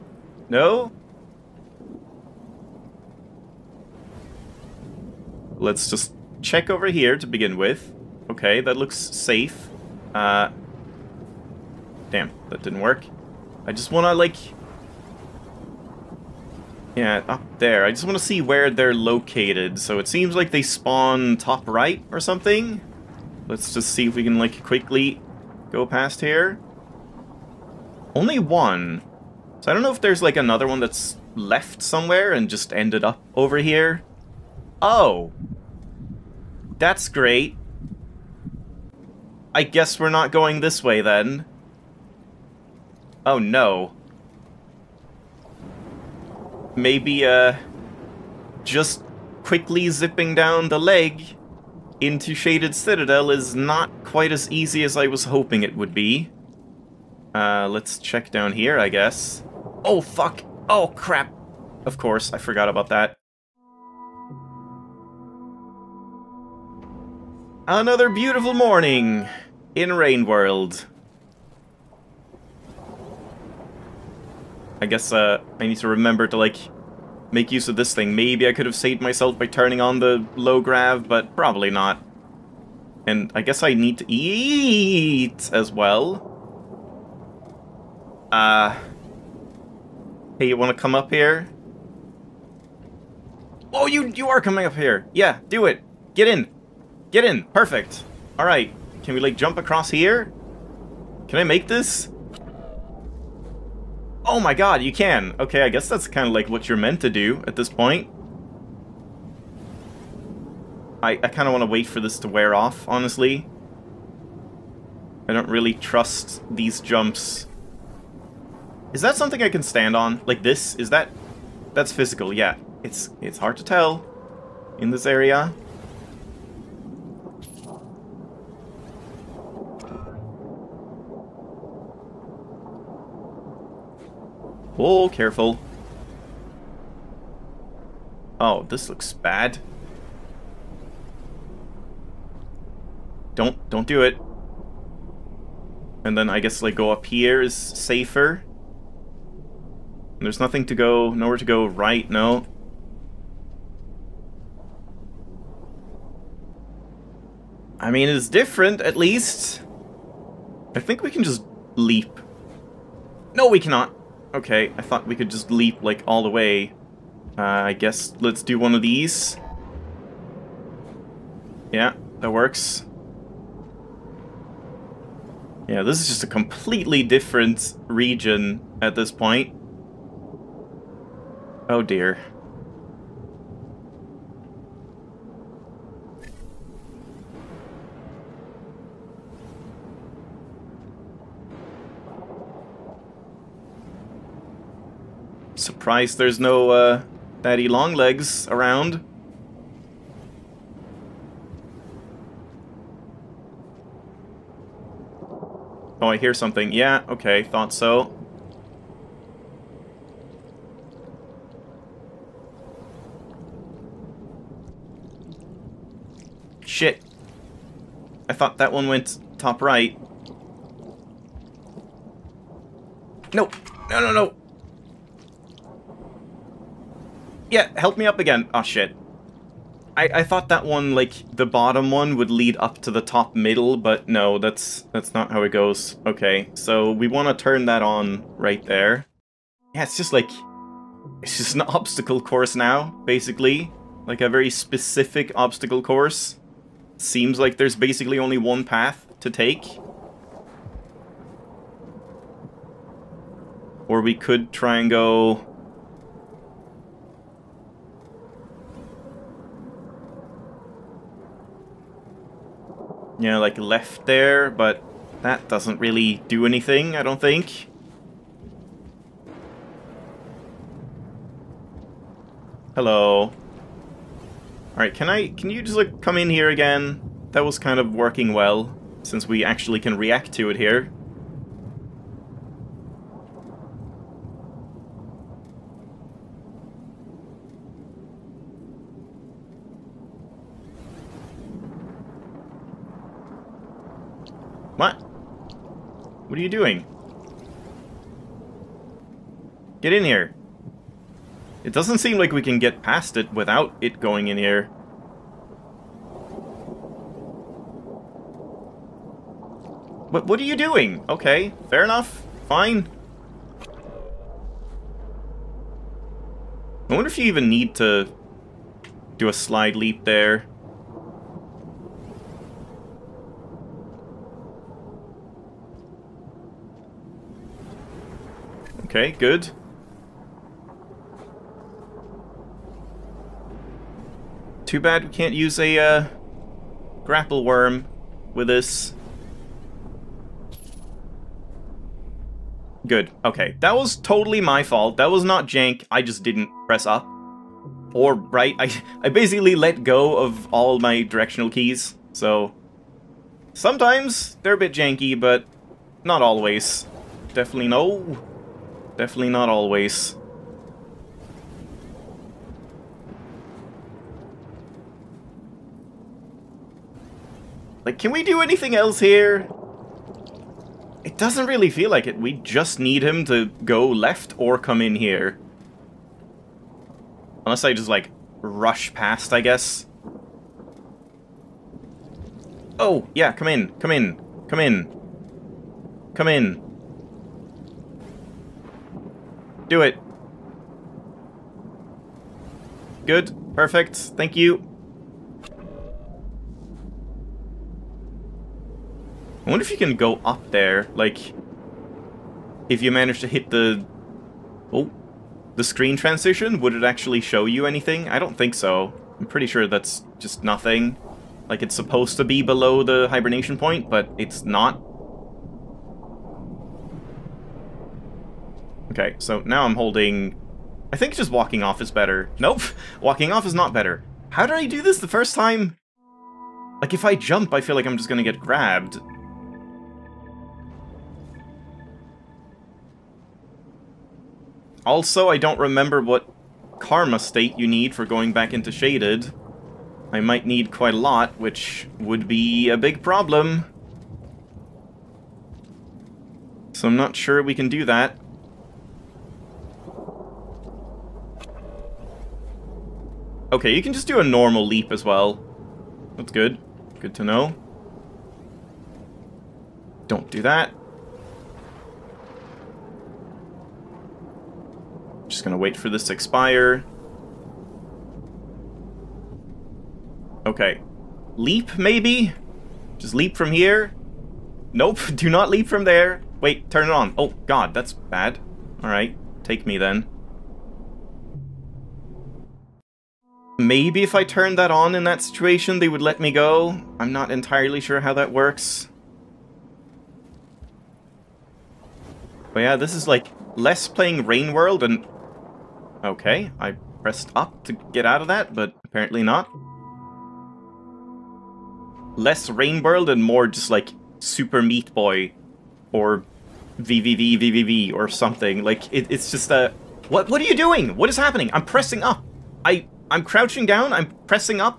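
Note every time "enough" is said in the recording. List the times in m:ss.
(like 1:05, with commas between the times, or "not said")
5:11.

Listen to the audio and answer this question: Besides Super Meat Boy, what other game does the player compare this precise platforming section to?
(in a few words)
VVVVVV.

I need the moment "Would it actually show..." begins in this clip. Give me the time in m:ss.
6:46.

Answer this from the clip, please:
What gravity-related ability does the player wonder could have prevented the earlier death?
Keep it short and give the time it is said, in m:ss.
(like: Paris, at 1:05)
low grav, at 1:20.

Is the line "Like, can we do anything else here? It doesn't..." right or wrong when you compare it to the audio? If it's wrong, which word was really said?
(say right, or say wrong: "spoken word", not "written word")
right.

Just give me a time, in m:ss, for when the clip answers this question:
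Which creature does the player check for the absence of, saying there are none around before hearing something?
3:17.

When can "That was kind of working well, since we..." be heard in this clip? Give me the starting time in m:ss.
4:37.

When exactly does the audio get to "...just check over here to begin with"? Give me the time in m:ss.
0:05.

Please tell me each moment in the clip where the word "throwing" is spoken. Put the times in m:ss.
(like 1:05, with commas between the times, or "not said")
not said.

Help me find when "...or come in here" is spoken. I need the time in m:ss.
6:14.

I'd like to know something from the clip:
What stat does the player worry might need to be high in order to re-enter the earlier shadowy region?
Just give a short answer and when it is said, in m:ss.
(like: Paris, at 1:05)
karma, at 7:16.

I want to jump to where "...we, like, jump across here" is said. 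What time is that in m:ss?
1:39.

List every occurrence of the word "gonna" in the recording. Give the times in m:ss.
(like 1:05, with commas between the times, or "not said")
7:08, 7:45.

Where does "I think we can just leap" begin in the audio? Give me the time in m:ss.
2:40.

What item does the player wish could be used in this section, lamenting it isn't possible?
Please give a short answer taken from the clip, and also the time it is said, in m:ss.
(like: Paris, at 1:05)
grapple worm, at 5:37.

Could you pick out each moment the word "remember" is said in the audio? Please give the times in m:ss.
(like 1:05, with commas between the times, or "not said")
1:15, 7:15.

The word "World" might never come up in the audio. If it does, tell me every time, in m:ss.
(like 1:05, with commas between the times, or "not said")
1:10, 8:14, 8:22.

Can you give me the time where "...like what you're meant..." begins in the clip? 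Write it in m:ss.
1:46.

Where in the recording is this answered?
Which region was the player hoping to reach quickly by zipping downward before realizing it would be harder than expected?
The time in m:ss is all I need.
0:52.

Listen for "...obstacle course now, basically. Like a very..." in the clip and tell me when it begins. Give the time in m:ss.
4:01.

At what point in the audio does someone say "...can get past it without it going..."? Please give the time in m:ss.
5:02.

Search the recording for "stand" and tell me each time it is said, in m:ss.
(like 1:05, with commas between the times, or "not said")
1:59.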